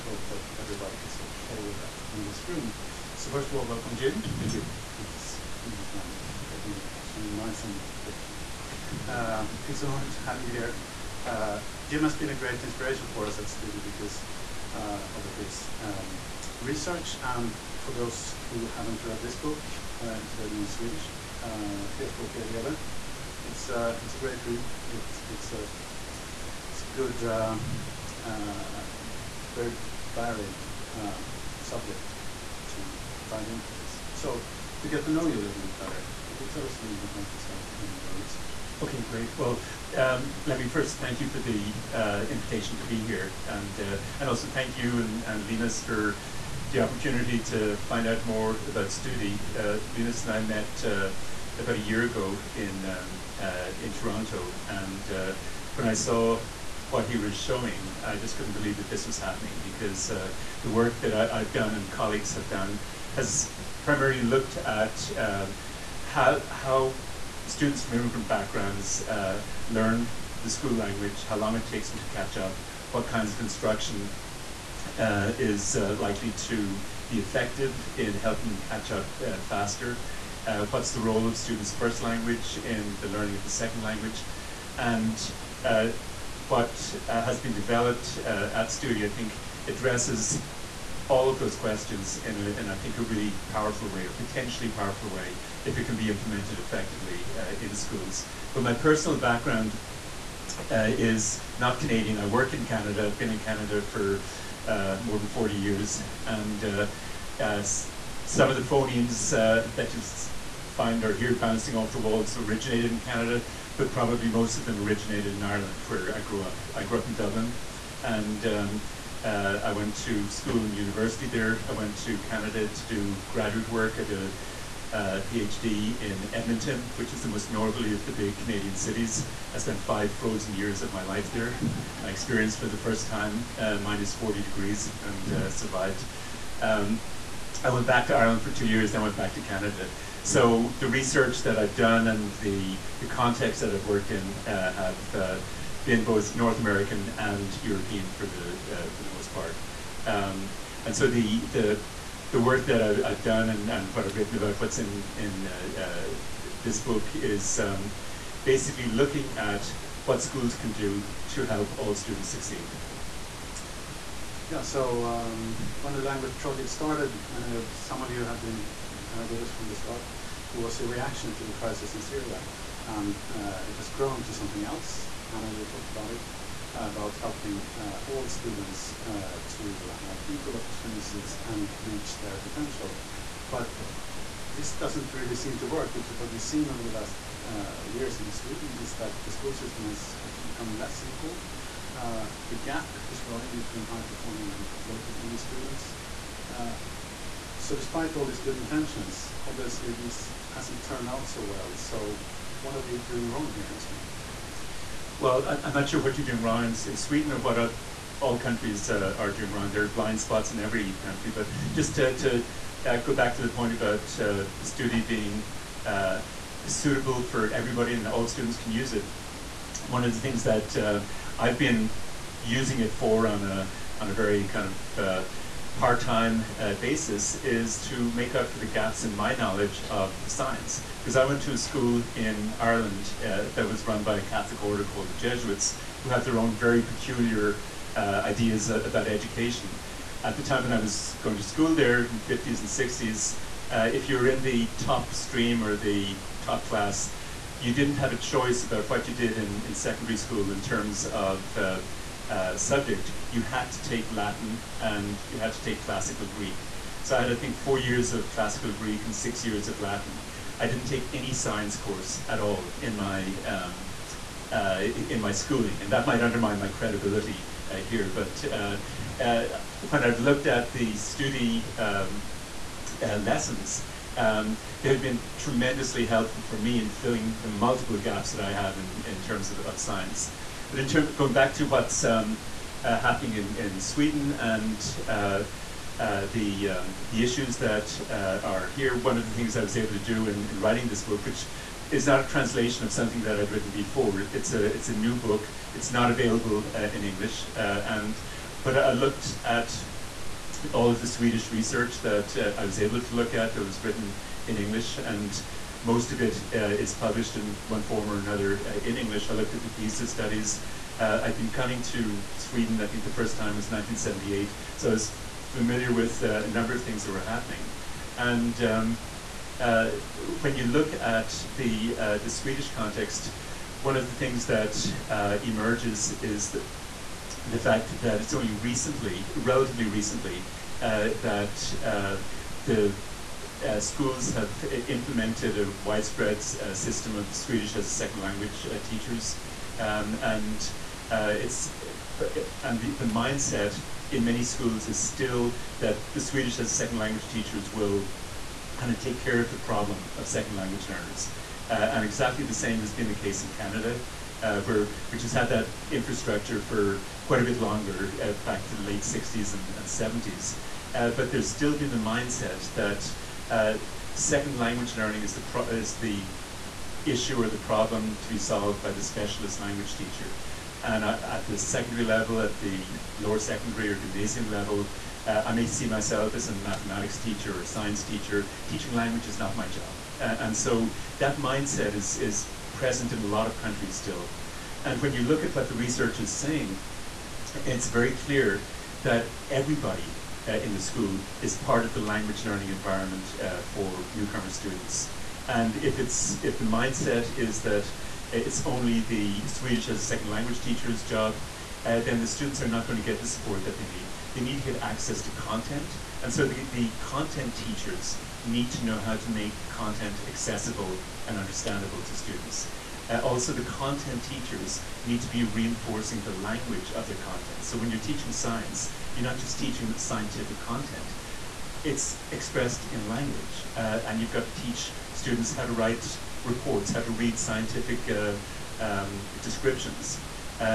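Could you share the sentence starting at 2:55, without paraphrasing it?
Anna, you talked about it, uh, about helping uh, all students uh, to have equal opportunities and reach their potential.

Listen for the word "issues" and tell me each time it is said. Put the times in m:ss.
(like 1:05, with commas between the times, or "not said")
4:47, 6:07.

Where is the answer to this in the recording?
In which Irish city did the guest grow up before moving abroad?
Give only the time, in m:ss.
1:57.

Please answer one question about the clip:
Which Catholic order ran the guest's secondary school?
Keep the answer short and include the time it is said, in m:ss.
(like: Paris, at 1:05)
Jesuits, at 3:55.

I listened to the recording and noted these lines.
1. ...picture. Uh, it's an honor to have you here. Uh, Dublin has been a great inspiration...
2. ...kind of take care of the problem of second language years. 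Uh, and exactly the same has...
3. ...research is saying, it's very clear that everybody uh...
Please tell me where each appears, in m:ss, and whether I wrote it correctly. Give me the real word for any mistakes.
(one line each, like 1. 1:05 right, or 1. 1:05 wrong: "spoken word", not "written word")
1. 0:08 wrong: "Jim", not "Dublin"
2. 5:48 wrong: "learners", not "years"
3. 6:25 right.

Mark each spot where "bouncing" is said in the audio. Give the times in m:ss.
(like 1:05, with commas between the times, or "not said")
1:51.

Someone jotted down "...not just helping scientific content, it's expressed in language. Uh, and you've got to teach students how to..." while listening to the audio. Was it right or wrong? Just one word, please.
wrong.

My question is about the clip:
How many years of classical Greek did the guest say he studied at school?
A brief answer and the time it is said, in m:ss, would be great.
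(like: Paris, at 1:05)
4, at 4:17.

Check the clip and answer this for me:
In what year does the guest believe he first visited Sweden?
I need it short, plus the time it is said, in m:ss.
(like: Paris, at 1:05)
1978, at 5:13.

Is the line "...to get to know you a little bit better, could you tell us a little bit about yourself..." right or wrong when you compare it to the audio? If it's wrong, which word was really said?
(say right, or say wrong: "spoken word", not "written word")
right.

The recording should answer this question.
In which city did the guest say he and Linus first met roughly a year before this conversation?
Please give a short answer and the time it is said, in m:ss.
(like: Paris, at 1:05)
Toronto, at 0:53.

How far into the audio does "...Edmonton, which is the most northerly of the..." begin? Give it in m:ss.
2:06.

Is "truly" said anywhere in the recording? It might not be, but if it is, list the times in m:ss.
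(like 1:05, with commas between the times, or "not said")
not said.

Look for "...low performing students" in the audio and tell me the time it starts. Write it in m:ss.
3:14.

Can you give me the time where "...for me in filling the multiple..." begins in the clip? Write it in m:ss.
4:36.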